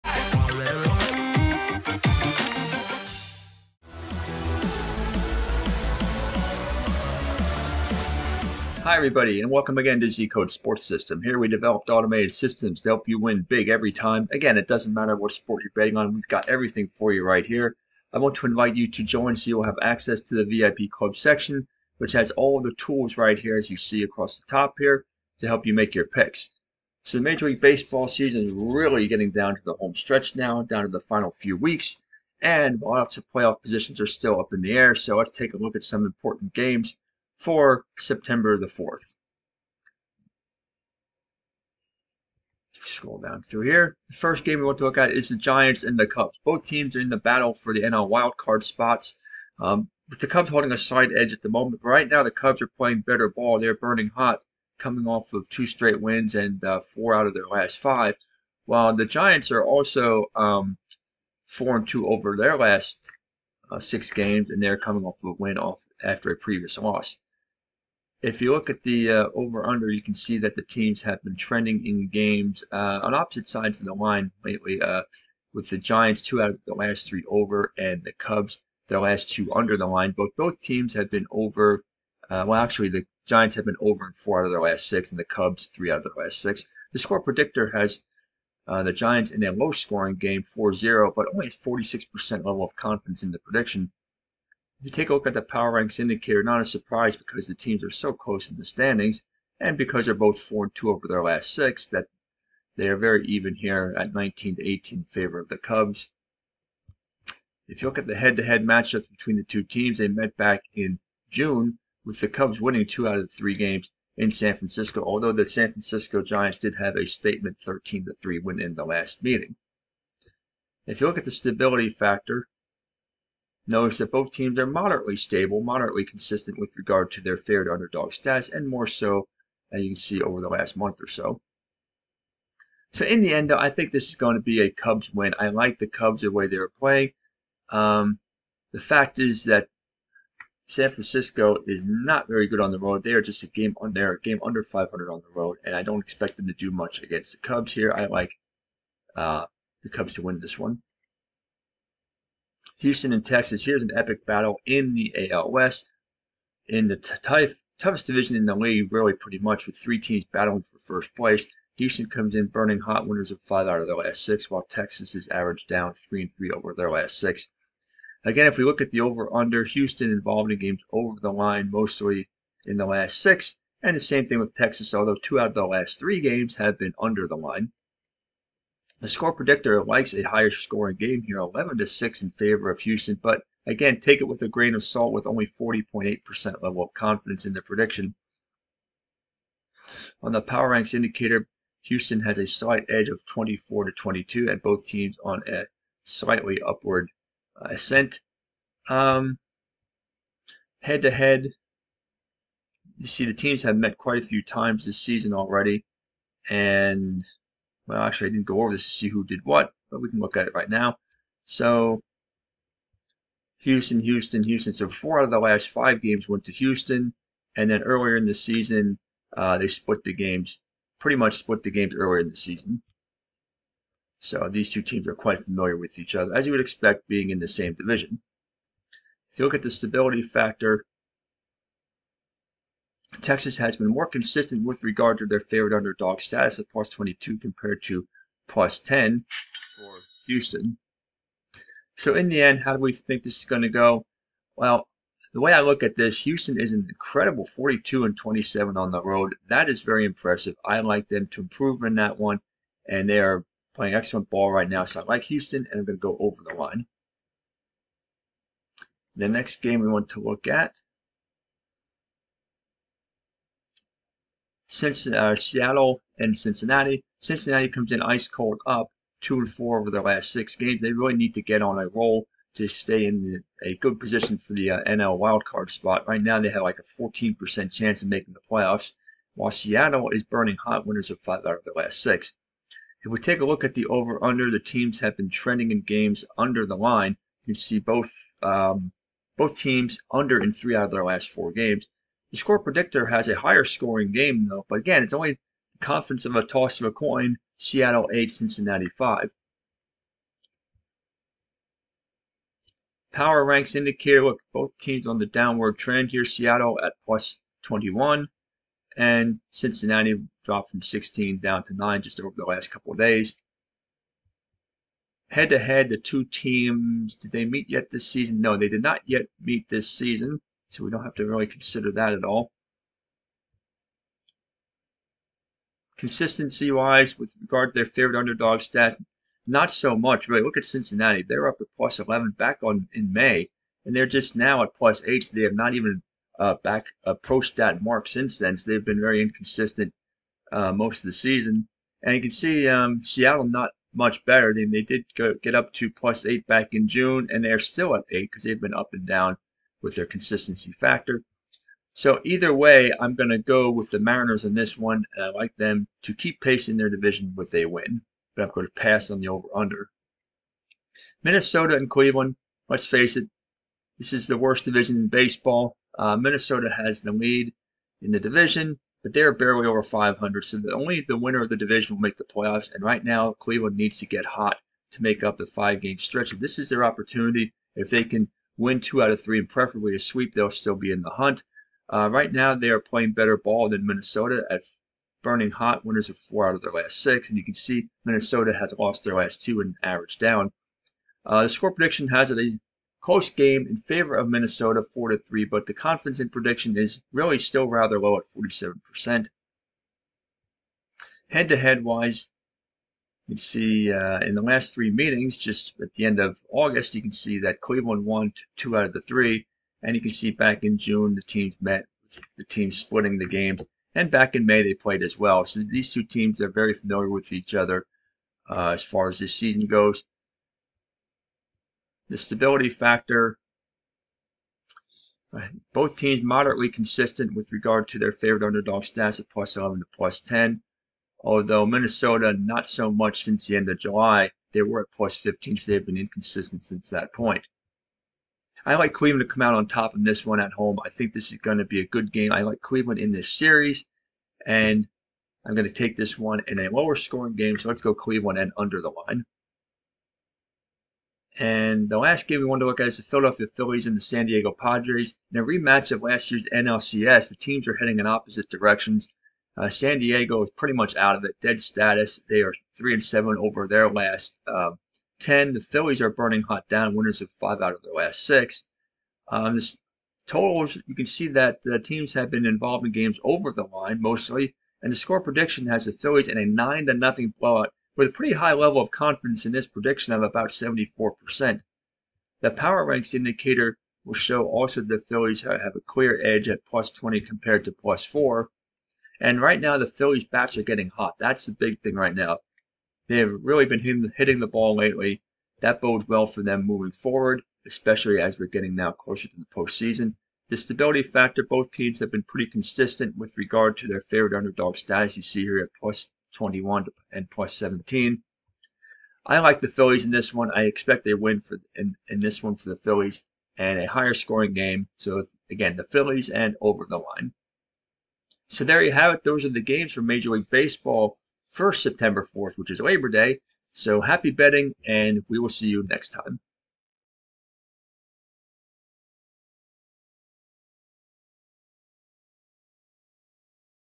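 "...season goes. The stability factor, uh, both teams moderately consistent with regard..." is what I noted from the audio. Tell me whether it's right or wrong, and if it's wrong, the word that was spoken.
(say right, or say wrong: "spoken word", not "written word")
right.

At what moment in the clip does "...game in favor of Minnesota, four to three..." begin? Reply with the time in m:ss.
6:33.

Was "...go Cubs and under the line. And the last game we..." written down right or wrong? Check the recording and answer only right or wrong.
wrong.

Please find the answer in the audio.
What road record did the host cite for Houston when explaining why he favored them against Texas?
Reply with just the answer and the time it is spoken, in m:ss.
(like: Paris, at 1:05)
42 and 27, at 4:07.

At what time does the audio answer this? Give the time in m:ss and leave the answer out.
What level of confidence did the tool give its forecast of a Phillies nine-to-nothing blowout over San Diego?
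8:00.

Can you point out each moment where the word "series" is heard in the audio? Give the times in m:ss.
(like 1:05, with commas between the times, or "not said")
7:23.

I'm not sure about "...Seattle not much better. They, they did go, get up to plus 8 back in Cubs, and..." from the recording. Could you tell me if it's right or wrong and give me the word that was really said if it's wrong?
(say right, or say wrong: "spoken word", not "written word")
wrong: "June", not "Cubs".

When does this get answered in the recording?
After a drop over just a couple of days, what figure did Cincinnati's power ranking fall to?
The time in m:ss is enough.
5:11.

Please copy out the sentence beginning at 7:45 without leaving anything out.
The Phillies are burning hot down, winners of five out of their last six.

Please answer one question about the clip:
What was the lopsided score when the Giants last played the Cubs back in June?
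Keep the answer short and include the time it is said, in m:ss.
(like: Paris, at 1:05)
13-3, at 1:57.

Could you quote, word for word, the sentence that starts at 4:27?
Cincinnati comes in ice cold up two and four over their last six games.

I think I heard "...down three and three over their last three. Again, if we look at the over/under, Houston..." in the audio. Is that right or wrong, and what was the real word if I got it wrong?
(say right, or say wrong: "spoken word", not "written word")
wrong: "six", not "three".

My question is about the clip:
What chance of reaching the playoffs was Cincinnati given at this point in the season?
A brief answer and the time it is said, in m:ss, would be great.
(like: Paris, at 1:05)
14%, at 4:37.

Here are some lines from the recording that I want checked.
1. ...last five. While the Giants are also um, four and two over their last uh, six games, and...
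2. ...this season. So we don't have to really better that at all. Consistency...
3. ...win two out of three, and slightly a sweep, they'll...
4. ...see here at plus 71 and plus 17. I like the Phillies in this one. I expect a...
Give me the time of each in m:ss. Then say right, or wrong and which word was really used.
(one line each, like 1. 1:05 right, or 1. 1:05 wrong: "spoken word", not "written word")
1. 0:57 right
2. 5:19 wrong: "consider", not "better"
3. 6:18 wrong: "preferably", not "slightly"
4. 8:25 wrong: "21", not "71".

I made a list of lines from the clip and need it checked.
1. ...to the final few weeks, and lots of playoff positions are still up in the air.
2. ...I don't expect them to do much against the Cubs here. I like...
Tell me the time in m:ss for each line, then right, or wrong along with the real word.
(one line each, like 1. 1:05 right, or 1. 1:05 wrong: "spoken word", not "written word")
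1. 0:30 right
2. 2:25 right.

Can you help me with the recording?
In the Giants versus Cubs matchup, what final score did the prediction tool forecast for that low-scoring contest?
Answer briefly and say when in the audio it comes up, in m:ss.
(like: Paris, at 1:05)
4-0, at 1:30.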